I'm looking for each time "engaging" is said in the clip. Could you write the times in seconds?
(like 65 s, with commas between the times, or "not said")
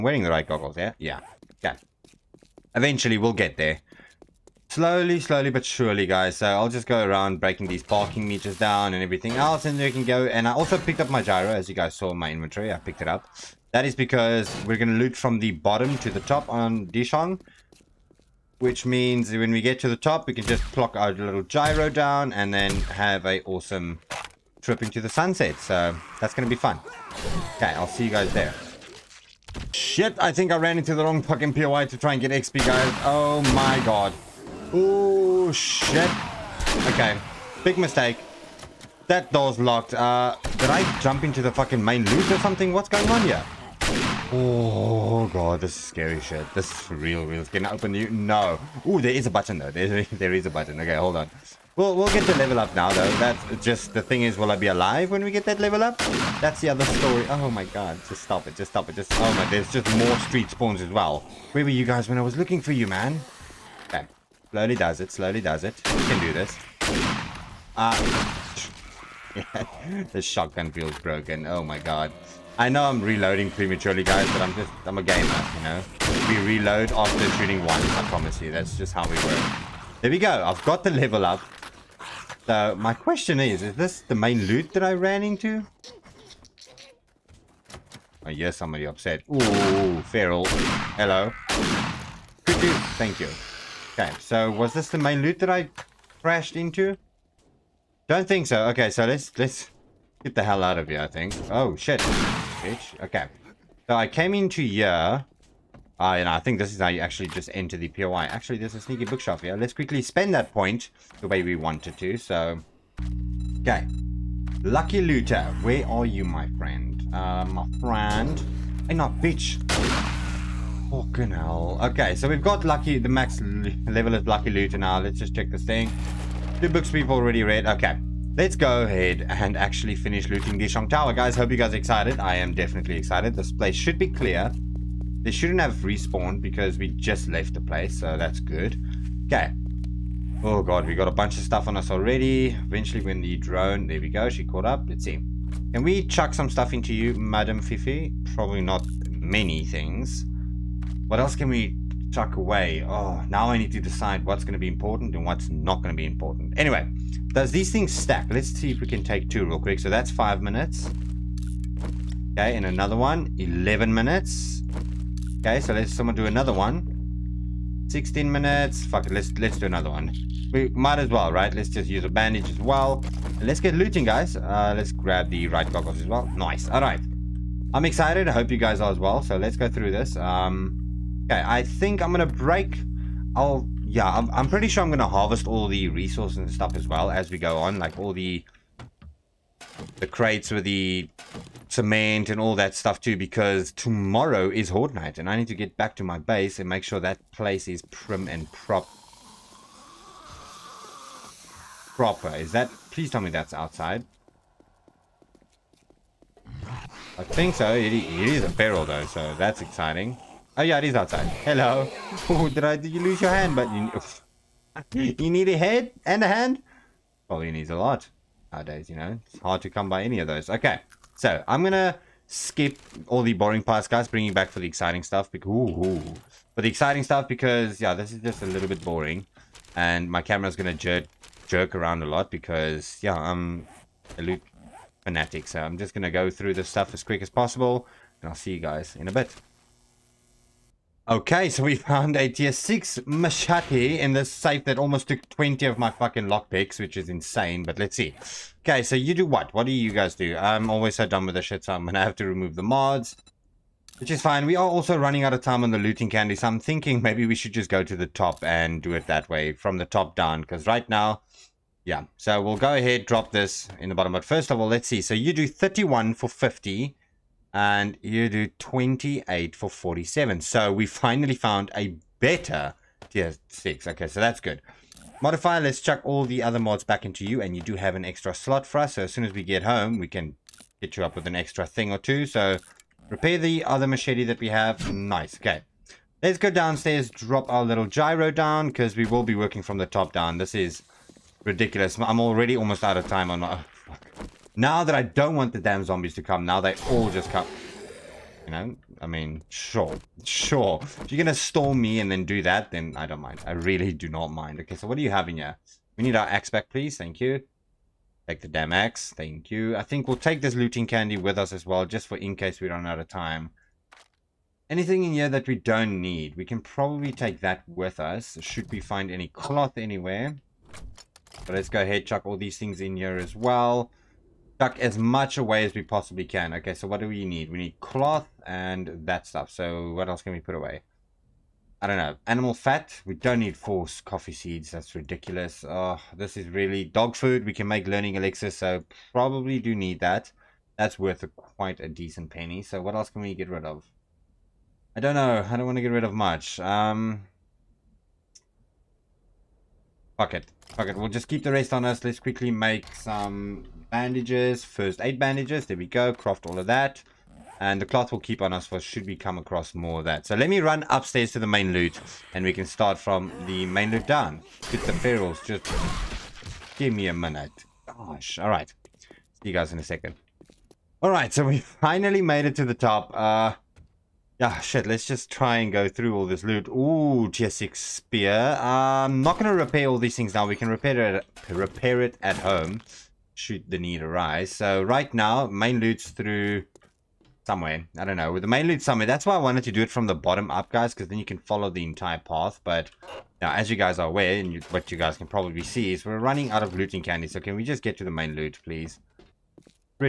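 not said.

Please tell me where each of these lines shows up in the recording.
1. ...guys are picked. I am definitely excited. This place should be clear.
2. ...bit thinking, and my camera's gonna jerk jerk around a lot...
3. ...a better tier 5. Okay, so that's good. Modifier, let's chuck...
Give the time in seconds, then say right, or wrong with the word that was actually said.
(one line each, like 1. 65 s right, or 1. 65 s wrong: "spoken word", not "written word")
1. 131 s wrong: "excited", not "picked"
2. 228 s wrong: "boring", not "thinking"
3. 271 s wrong: "6", not "5".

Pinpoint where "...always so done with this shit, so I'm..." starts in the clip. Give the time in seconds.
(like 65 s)
250 s.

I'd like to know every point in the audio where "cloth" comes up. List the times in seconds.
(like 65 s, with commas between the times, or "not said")
319 s, 327 s, 357 s.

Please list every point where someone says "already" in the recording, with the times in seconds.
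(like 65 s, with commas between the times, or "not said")
127 s, 141 s, 292 s.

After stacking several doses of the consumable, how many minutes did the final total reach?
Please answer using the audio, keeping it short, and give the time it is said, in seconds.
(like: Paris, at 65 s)
16 minutes, at 167 s.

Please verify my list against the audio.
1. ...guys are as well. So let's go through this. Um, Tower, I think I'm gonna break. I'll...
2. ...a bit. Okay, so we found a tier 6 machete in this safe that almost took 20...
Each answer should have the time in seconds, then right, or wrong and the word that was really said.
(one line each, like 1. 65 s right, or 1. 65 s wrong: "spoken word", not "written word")
1. 178 s wrong: "Okay", not "Tower"
2. 239 s right.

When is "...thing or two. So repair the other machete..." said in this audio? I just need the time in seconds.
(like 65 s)
281 s.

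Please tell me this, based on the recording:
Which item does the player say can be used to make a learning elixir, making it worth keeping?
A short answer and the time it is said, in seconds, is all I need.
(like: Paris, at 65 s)
Dog food, at 336 s.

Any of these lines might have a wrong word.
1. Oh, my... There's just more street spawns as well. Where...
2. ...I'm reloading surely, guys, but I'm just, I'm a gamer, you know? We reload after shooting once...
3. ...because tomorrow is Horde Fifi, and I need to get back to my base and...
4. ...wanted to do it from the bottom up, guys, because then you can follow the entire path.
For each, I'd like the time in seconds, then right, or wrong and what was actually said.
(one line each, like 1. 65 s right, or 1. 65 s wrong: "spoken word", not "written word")
1. 59 s right
2. 72 s wrong: "prematurely", not "surely"
3. 193 s wrong: "Night", not "Fifi"
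4. 389 s right.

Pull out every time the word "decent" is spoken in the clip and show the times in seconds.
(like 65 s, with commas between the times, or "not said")
341 s.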